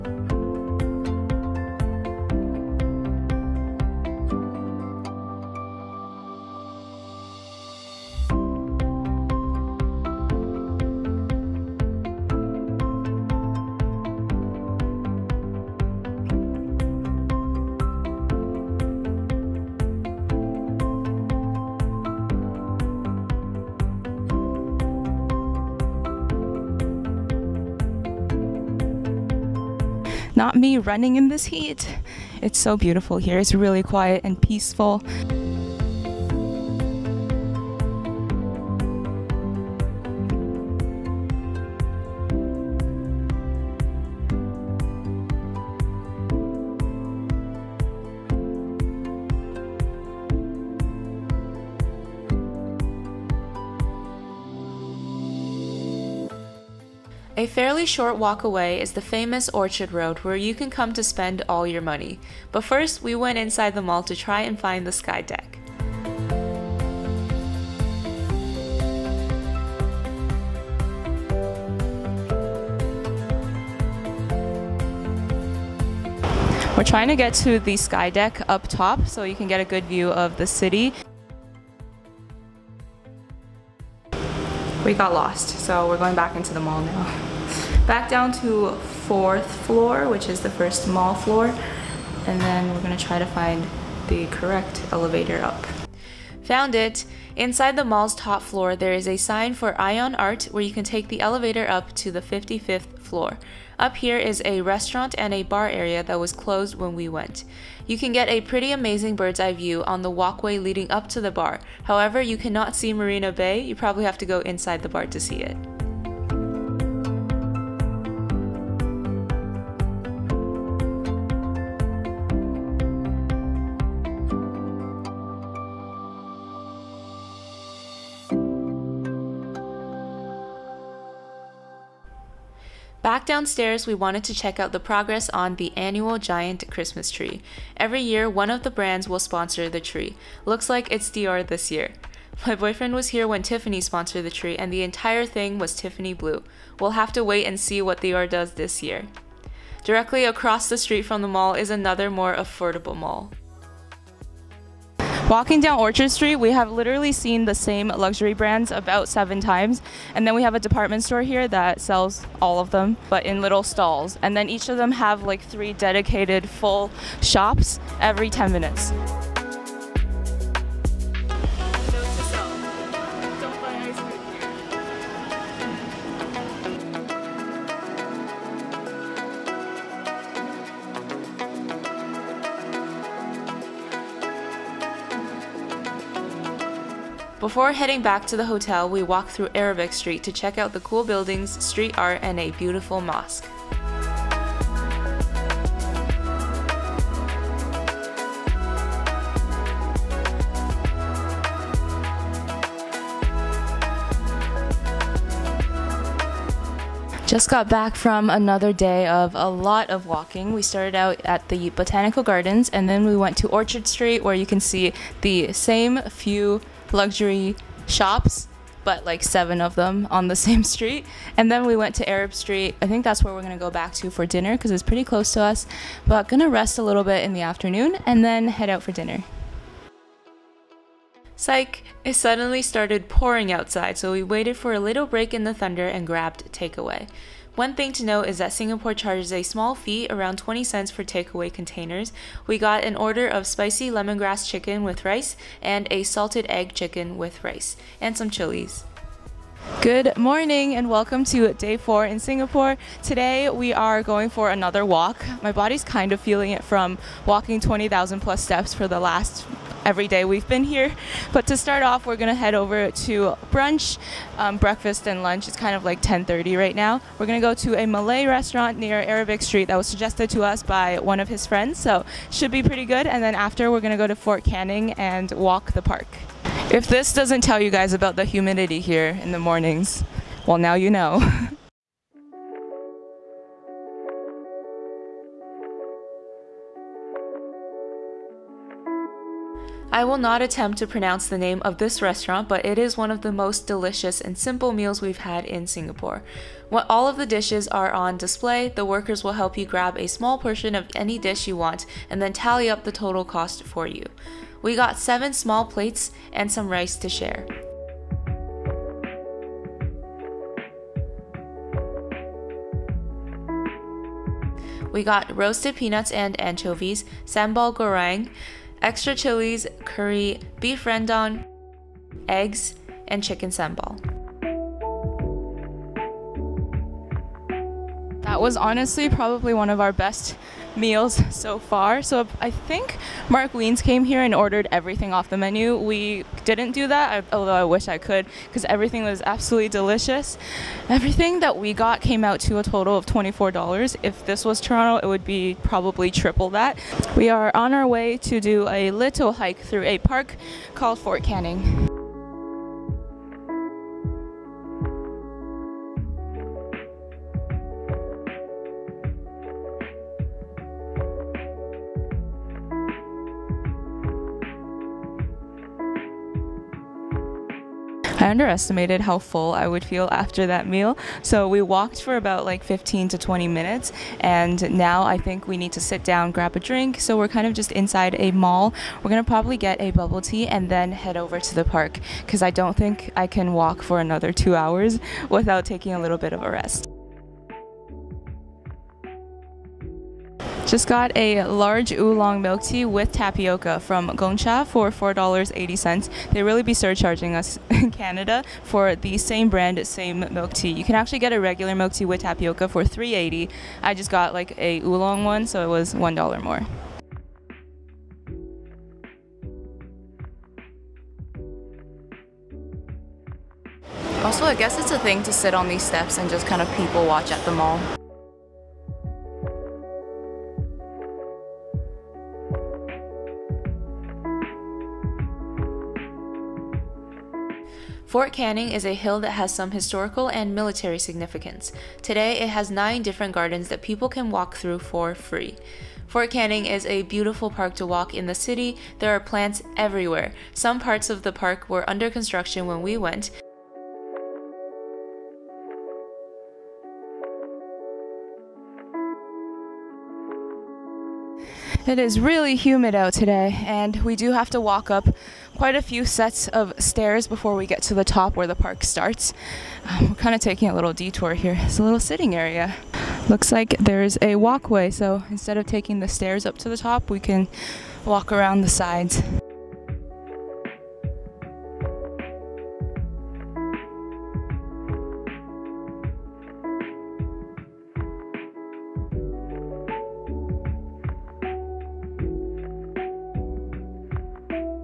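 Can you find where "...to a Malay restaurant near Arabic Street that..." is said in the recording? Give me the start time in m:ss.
4:27.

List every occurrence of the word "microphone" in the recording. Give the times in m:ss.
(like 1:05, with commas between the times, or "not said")
not said.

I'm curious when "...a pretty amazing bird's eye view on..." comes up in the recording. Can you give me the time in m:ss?
1:48.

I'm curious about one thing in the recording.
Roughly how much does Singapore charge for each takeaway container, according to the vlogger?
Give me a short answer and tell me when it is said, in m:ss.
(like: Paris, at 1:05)
20 cents, at 4:00.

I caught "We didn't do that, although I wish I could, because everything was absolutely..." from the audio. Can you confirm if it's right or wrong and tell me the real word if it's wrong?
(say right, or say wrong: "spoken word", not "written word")
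right.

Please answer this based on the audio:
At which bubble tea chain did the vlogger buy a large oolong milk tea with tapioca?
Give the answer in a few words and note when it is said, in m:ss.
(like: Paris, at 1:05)
Gong Cha, at 6:34.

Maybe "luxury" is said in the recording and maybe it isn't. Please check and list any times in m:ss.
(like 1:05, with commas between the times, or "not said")
2:37, 3:36.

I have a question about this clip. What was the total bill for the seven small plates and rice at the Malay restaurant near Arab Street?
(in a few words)
$24.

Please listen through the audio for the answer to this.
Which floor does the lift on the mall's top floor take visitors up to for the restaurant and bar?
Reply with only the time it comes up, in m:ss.
1:42.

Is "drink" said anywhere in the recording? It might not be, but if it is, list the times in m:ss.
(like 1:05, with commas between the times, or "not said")
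6:16.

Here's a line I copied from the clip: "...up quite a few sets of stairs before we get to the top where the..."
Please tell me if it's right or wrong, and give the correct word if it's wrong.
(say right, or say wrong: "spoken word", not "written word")
right.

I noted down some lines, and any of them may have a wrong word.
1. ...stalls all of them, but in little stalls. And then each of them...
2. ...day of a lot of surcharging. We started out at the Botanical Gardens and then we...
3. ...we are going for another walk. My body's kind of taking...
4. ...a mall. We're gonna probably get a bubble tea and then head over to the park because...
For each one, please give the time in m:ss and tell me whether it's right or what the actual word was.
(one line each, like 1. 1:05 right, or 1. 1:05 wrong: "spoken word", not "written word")
1. 2:41 wrong: "sells", not "stalls"
2. 3:28 wrong: "walking", not "surcharging"
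3. 4:13 wrong: "feeling", not "taking"
4. 6:18 right.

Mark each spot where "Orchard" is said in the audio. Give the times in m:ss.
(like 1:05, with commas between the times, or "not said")
0:59, 2:35, 3:33.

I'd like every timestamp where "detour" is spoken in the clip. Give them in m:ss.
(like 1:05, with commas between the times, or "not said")
7:40.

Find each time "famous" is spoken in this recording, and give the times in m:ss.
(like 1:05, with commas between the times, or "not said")
0:59.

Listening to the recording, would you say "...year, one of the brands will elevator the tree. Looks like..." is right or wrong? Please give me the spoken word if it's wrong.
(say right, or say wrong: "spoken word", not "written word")
wrong: "sponsor", not "elevator".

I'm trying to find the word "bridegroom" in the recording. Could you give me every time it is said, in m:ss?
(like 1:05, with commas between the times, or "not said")
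not said.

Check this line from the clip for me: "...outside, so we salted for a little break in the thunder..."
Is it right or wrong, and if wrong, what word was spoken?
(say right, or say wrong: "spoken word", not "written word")
wrong: "waited", not "salted".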